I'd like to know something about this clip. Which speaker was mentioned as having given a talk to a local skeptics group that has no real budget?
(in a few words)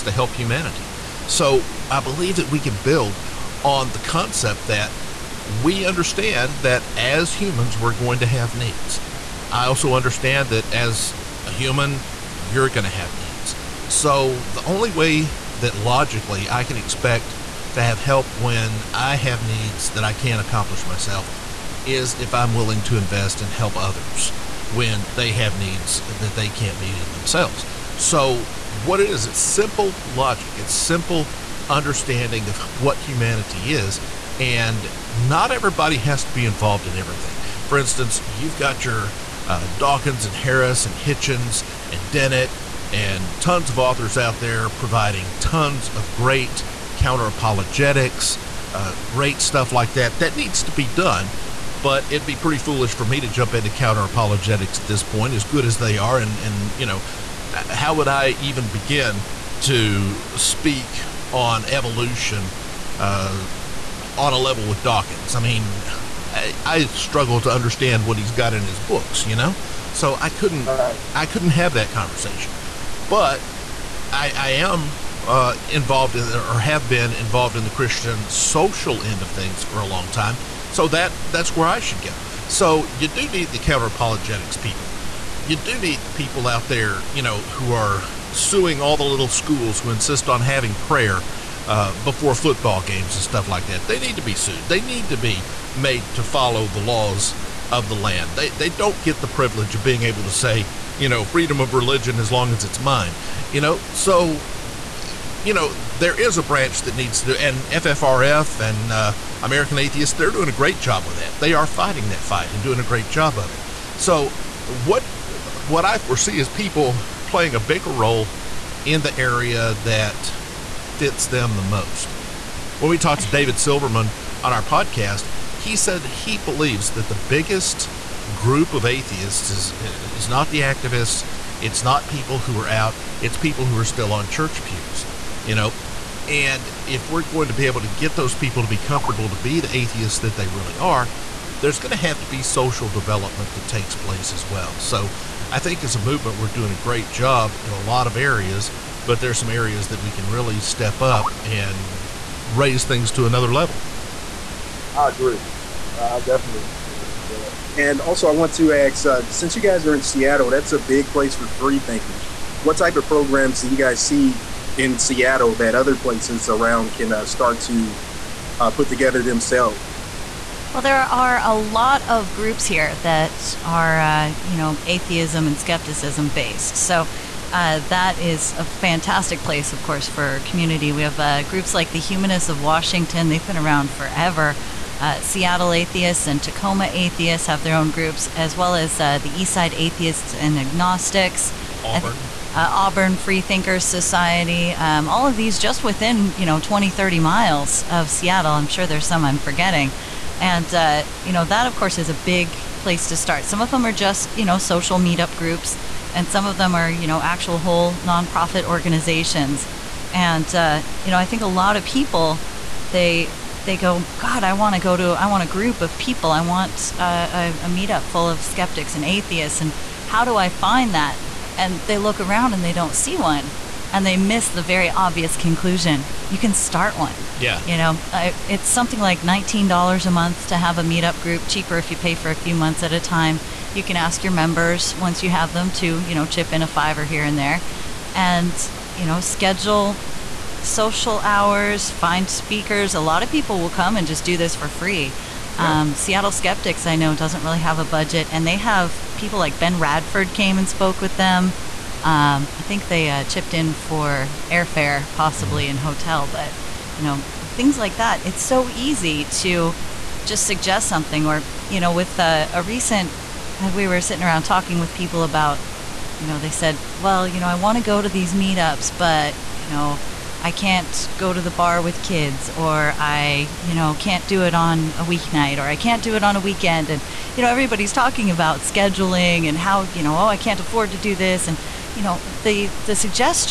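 Ben Radford.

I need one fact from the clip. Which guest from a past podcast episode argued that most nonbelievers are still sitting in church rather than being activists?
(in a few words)
David Silverman.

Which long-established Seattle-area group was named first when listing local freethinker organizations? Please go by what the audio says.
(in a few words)
Humanists of Washington.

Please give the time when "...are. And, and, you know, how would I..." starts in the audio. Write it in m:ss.
0:55.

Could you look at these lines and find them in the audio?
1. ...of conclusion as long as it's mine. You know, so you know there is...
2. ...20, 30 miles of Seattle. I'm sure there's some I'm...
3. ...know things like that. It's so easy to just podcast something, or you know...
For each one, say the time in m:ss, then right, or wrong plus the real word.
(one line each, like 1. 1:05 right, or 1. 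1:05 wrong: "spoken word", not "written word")
1. 1:41 wrong: "religion", not "conclusion"
2. 3:16 right
3. 4:17 wrong: "suggest", not "podcast".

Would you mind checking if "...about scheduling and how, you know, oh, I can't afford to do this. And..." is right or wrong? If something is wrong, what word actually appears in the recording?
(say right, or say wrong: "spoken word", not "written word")
right.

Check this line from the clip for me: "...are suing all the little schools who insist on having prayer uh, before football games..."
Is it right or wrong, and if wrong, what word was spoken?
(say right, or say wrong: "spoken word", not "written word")
right.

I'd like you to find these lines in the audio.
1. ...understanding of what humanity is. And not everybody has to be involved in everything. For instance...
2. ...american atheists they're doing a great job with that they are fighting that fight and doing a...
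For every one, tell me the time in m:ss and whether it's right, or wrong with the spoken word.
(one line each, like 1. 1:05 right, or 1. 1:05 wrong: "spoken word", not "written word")
1. 0:31 right
2. 1:49 right.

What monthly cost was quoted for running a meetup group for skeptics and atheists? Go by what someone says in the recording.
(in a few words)
$19.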